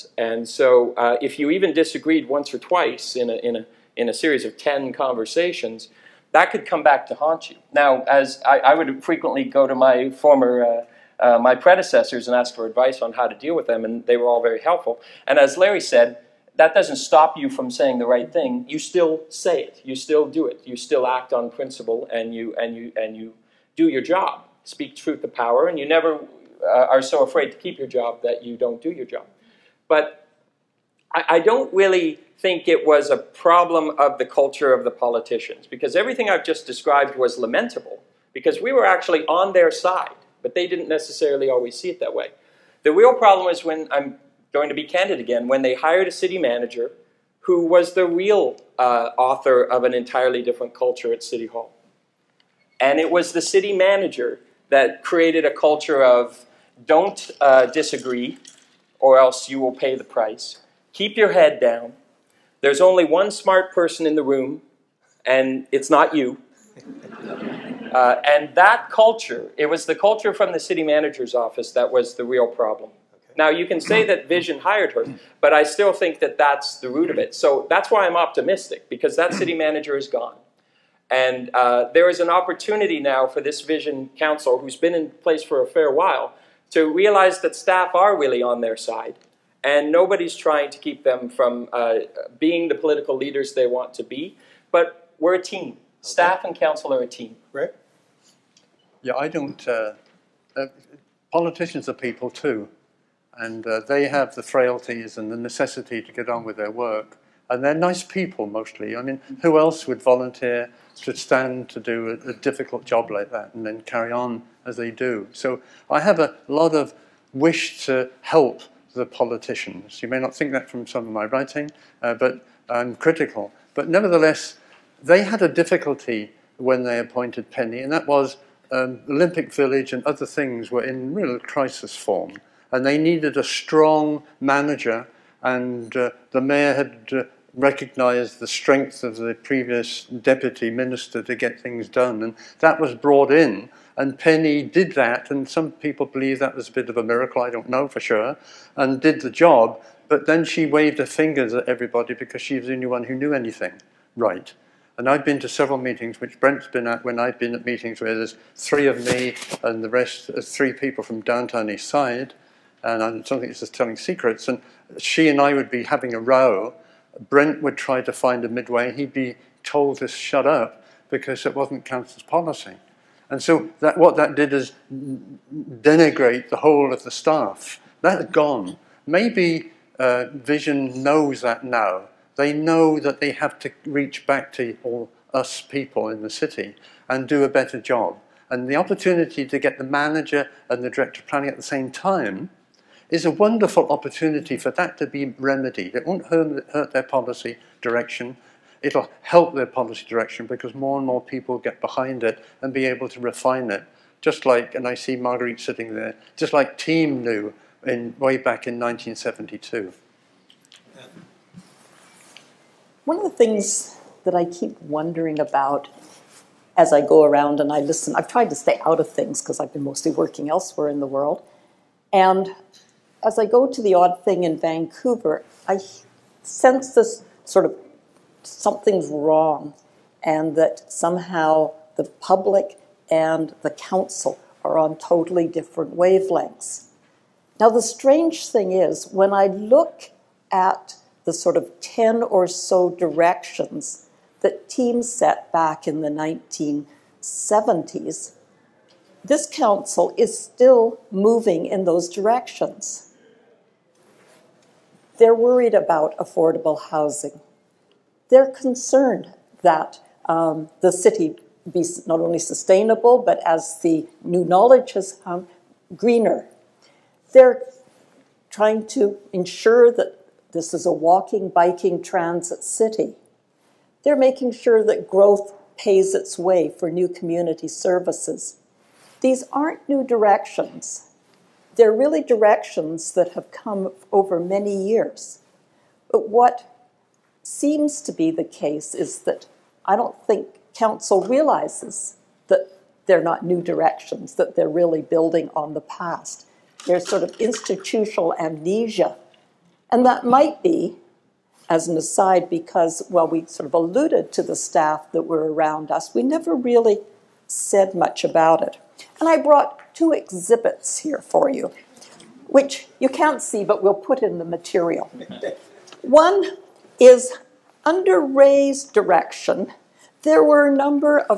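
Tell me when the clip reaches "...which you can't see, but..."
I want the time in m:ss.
5:12.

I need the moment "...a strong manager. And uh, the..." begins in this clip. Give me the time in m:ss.
2:13.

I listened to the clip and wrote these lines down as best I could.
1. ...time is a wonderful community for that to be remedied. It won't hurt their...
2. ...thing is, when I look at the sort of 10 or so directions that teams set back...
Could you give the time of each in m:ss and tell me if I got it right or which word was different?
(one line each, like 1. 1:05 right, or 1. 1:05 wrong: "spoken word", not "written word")
1. 3:11 wrong: "opportunity", not "community"
2. 3:58 right.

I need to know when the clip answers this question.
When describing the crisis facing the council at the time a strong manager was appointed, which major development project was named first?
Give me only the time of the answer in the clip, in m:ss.
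2:09.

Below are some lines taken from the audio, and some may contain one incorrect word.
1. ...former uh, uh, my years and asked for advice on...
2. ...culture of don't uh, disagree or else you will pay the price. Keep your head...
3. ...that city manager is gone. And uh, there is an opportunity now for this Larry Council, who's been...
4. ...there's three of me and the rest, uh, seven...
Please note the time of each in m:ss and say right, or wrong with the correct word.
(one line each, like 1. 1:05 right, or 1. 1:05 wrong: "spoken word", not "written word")
1. 0:10 wrong: "predecessors", not "years"
2. 0:55 right
3. 1:19 wrong: "Vision", not "Larry"
4. 2:38 wrong: "three", not "seven".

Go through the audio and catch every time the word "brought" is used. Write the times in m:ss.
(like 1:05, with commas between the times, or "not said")
2:22, 5:09.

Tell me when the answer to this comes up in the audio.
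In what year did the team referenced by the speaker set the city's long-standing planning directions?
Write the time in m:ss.
3:28.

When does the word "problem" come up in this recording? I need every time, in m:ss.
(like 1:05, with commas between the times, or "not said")
0:33, 0:43, 1:12.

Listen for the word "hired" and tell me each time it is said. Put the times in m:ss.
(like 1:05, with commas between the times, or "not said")
0:45, 1:14.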